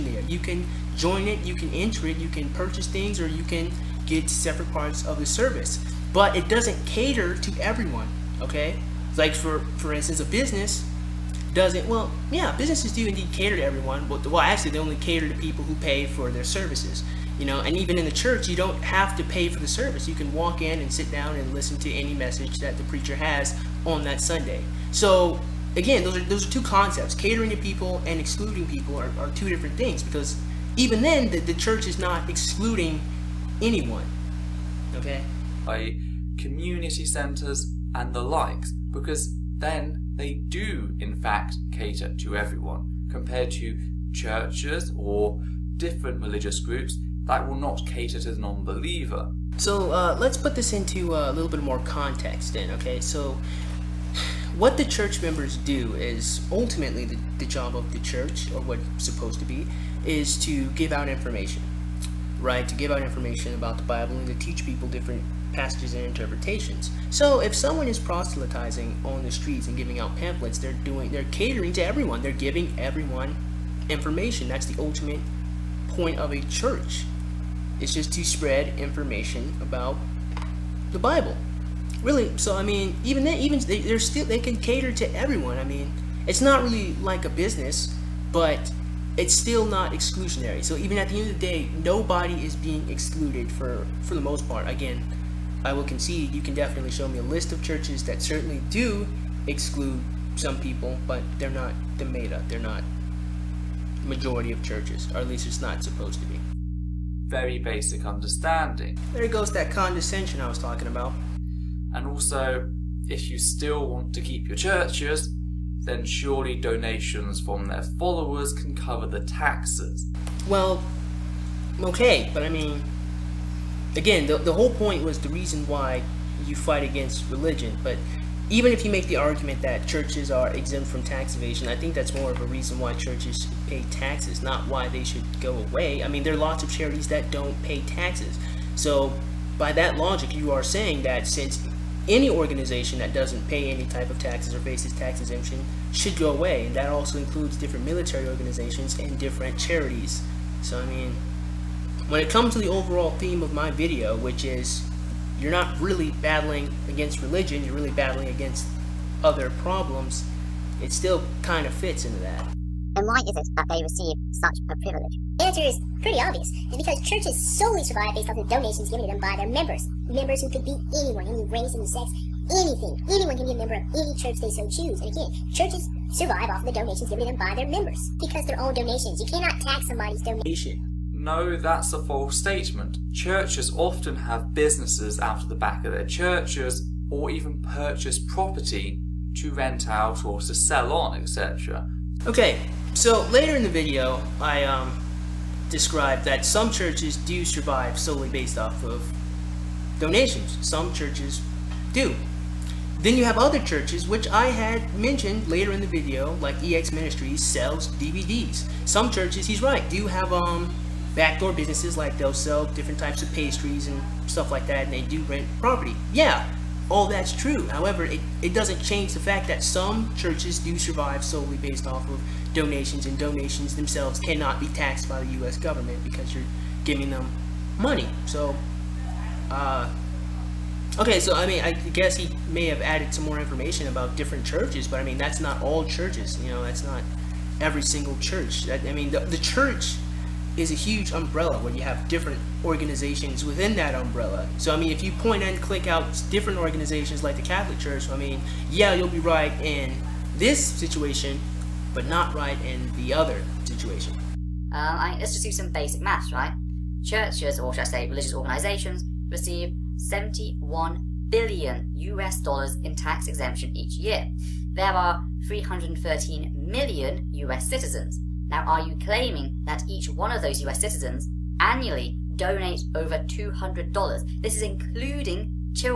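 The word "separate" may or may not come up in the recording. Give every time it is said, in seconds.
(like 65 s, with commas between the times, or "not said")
4 s.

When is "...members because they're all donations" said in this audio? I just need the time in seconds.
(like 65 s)
177 s.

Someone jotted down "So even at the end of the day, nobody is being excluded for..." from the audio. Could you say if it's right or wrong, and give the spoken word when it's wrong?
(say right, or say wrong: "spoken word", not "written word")
right.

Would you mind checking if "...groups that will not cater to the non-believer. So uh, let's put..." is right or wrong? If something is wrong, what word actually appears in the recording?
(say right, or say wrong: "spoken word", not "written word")
right.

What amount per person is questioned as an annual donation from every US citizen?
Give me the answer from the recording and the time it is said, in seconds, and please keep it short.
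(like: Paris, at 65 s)
$200, at 273 s.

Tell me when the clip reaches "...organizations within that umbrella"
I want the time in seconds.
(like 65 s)
242 s.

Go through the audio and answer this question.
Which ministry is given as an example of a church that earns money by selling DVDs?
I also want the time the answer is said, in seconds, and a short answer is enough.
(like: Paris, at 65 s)
EX Ministries, at 206 s.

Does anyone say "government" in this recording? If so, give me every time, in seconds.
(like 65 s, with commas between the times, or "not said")
225 s.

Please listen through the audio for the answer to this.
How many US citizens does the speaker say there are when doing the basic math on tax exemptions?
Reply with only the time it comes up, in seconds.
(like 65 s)
265 s.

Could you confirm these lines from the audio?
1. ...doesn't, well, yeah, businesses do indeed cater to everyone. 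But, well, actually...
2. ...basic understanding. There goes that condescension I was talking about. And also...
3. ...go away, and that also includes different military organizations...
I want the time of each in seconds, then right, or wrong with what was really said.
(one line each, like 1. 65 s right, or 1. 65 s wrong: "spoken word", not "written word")
1. 11 s right
2. 107 s right
3. 146 s right.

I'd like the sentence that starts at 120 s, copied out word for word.
Well, okay, but I mean, again, the, the whole point was the reason why you fight against religion.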